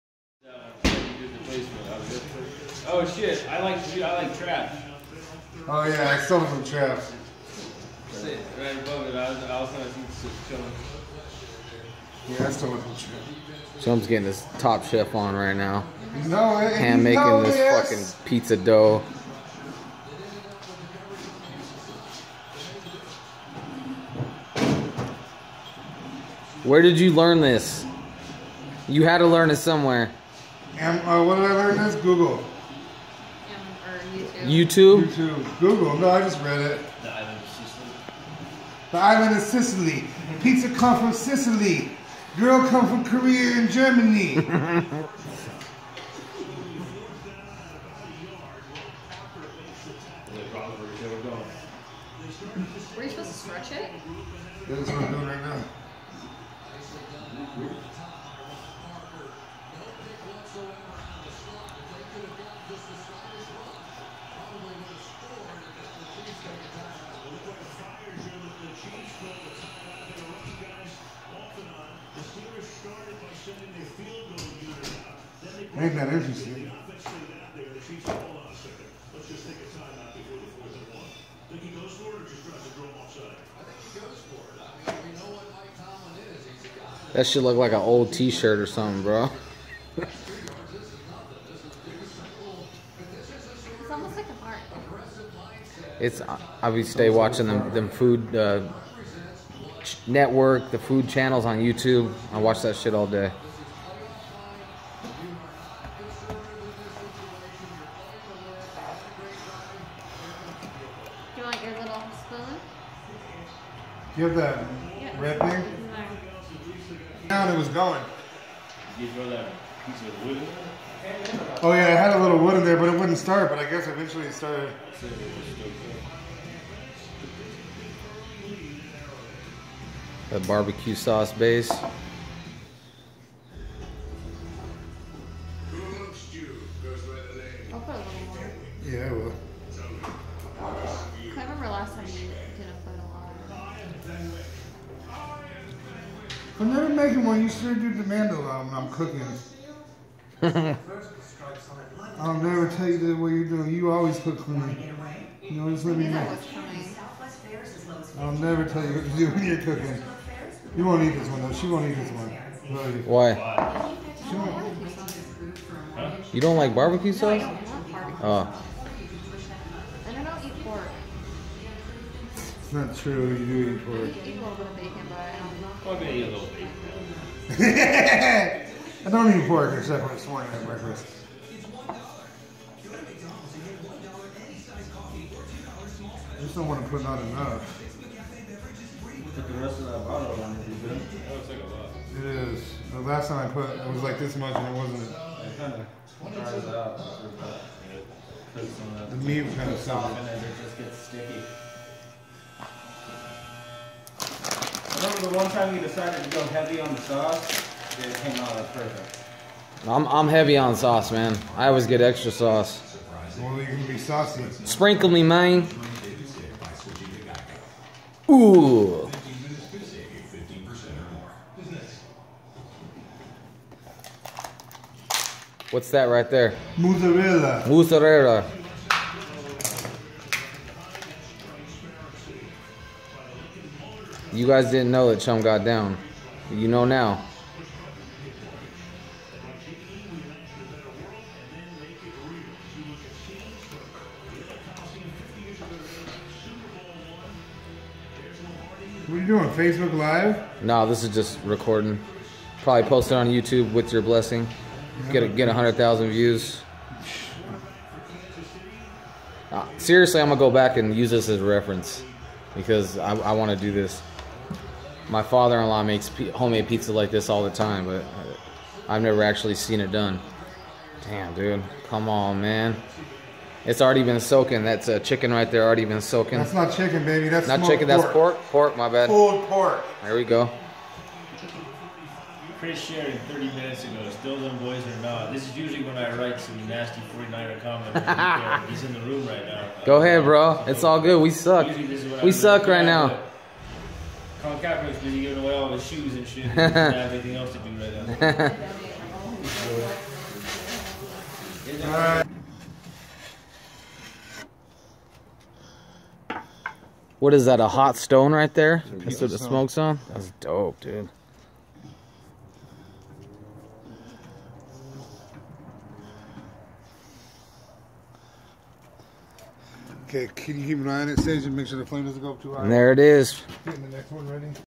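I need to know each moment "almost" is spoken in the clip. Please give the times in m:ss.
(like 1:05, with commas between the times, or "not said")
1:33.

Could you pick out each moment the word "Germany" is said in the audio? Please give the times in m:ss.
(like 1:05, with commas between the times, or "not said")
0:43.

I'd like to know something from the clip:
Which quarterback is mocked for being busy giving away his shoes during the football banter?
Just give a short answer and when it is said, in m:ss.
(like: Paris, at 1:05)
Colin Kaepernick, at 4:54.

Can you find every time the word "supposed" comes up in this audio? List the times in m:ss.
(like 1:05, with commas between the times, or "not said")
0:53.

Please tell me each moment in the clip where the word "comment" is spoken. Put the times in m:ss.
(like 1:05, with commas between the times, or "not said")
4:47.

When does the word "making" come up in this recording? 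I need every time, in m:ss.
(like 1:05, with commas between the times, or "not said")
0:17, 2:26.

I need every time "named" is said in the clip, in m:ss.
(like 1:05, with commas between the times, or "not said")
not said.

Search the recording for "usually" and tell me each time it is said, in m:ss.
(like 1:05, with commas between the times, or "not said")
4:45.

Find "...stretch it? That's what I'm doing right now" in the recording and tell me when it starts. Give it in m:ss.
0:53.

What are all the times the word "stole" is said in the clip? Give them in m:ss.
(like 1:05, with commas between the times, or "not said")
0:06, 0:12.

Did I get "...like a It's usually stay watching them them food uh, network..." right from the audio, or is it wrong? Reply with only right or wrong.
wrong.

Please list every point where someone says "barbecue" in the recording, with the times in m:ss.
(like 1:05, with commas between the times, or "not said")
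2:10, 2:46.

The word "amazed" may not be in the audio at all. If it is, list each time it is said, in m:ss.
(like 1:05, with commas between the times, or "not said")
not said.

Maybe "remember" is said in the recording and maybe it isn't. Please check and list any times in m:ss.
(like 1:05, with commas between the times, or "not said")
2:21, 3:25.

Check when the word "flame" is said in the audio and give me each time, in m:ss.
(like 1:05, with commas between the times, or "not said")
5:21.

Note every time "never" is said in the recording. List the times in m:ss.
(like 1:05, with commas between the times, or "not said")
2:26, 2:32, 2:38, 4:29.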